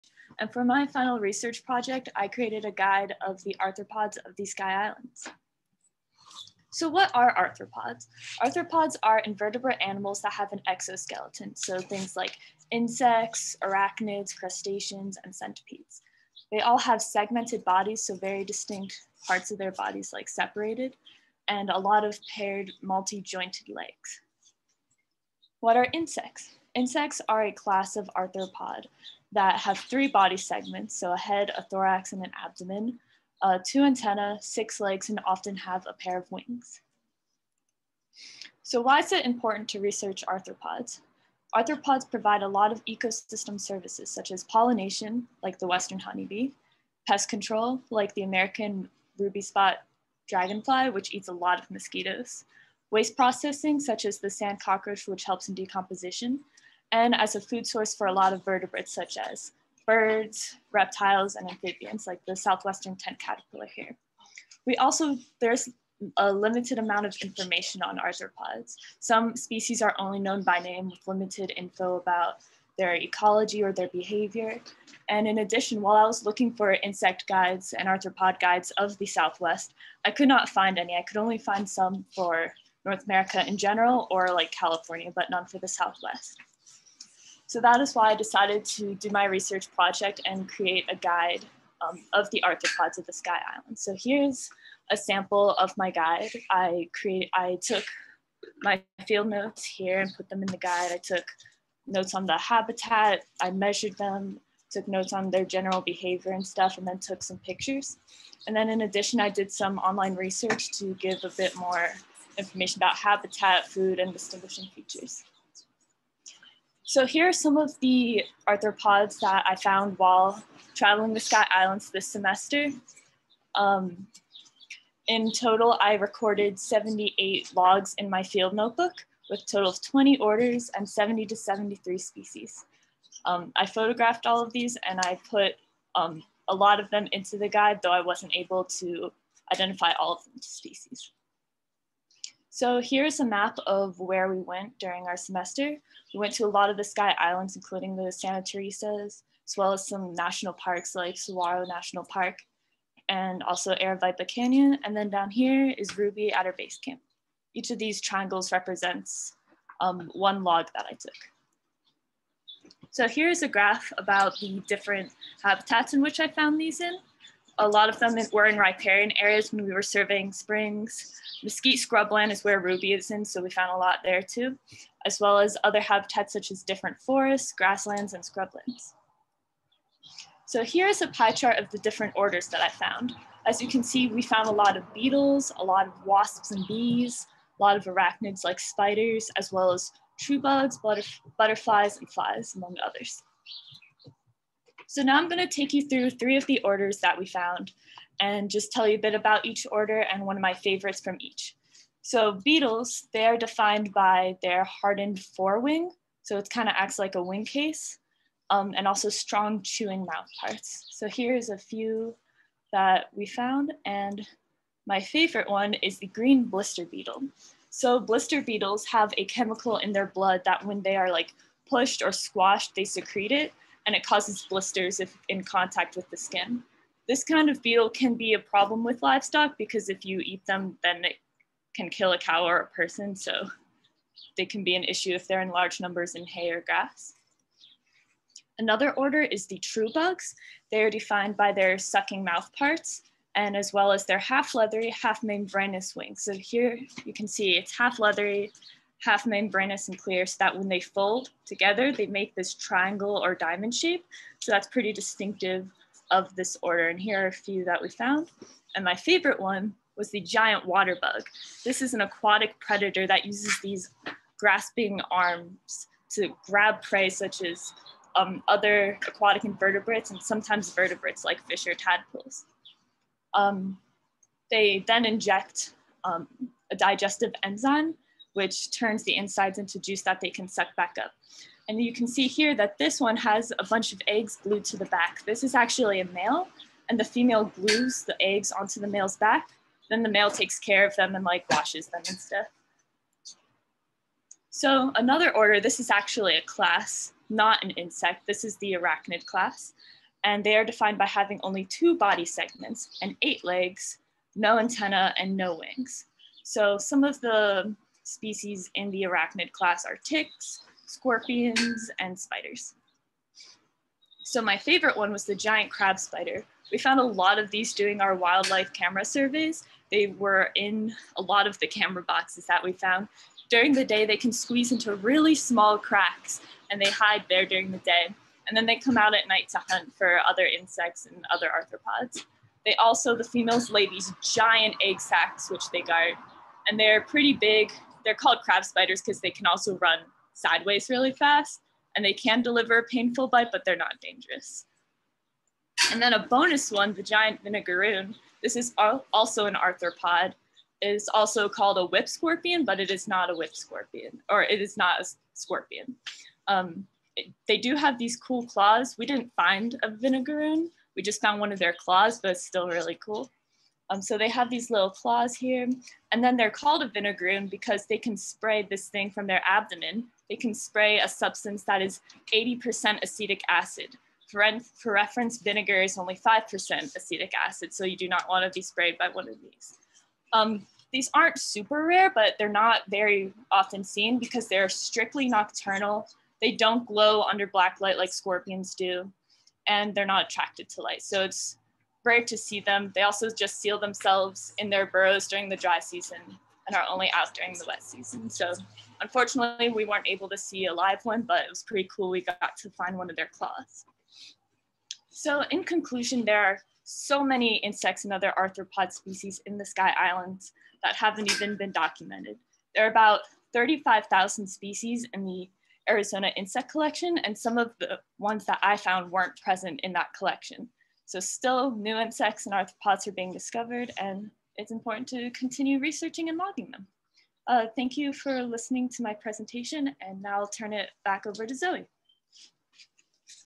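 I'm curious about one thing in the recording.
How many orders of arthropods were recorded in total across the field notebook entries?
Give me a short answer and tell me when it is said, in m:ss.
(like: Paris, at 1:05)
20, at 2:09.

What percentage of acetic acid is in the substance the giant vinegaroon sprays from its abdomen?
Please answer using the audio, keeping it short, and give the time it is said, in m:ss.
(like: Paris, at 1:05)
80%, at 6:12.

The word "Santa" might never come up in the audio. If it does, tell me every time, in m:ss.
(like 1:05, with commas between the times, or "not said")
2:28.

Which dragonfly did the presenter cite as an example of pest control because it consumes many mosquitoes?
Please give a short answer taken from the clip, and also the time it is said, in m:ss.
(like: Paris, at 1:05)
American ruby spot, at 0:48.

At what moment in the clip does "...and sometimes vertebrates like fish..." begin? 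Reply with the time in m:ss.
4:30.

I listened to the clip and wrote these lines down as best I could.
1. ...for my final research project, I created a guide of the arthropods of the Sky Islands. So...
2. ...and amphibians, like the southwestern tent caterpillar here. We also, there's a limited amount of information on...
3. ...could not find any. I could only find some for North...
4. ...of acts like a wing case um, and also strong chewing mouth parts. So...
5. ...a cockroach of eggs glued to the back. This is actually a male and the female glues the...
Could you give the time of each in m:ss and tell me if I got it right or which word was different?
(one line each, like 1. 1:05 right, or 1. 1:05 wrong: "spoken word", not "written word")
1. 0:00 right
2. 1:01 right
3. 1:20 right
4. 3:26 right
5. 4:43 wrong: "bunch", not "cockroach".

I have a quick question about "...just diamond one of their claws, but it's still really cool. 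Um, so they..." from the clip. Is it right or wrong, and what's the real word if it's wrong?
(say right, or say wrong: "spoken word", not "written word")
wrong: "found", not "diamond".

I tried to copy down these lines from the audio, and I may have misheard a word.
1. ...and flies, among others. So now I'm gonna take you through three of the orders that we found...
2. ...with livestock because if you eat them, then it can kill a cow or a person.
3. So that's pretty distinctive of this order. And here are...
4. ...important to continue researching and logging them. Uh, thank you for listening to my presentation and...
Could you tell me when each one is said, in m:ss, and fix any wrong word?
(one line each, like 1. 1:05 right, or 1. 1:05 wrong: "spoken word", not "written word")
1. 3:11 right
2. 3:48 right
3. 4:14 right
4. 7:04 right.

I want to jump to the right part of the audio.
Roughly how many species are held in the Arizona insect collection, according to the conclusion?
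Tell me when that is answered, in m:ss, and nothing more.
6:53.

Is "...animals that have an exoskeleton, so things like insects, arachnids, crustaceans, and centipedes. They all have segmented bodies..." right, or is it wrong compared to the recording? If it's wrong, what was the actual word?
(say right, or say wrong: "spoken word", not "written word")
right.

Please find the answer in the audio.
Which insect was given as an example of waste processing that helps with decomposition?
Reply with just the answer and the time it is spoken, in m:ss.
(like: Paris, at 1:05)
sand cockroach, at 0:54.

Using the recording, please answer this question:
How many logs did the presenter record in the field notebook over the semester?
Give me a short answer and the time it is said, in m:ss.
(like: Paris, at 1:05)
78, at 2:06.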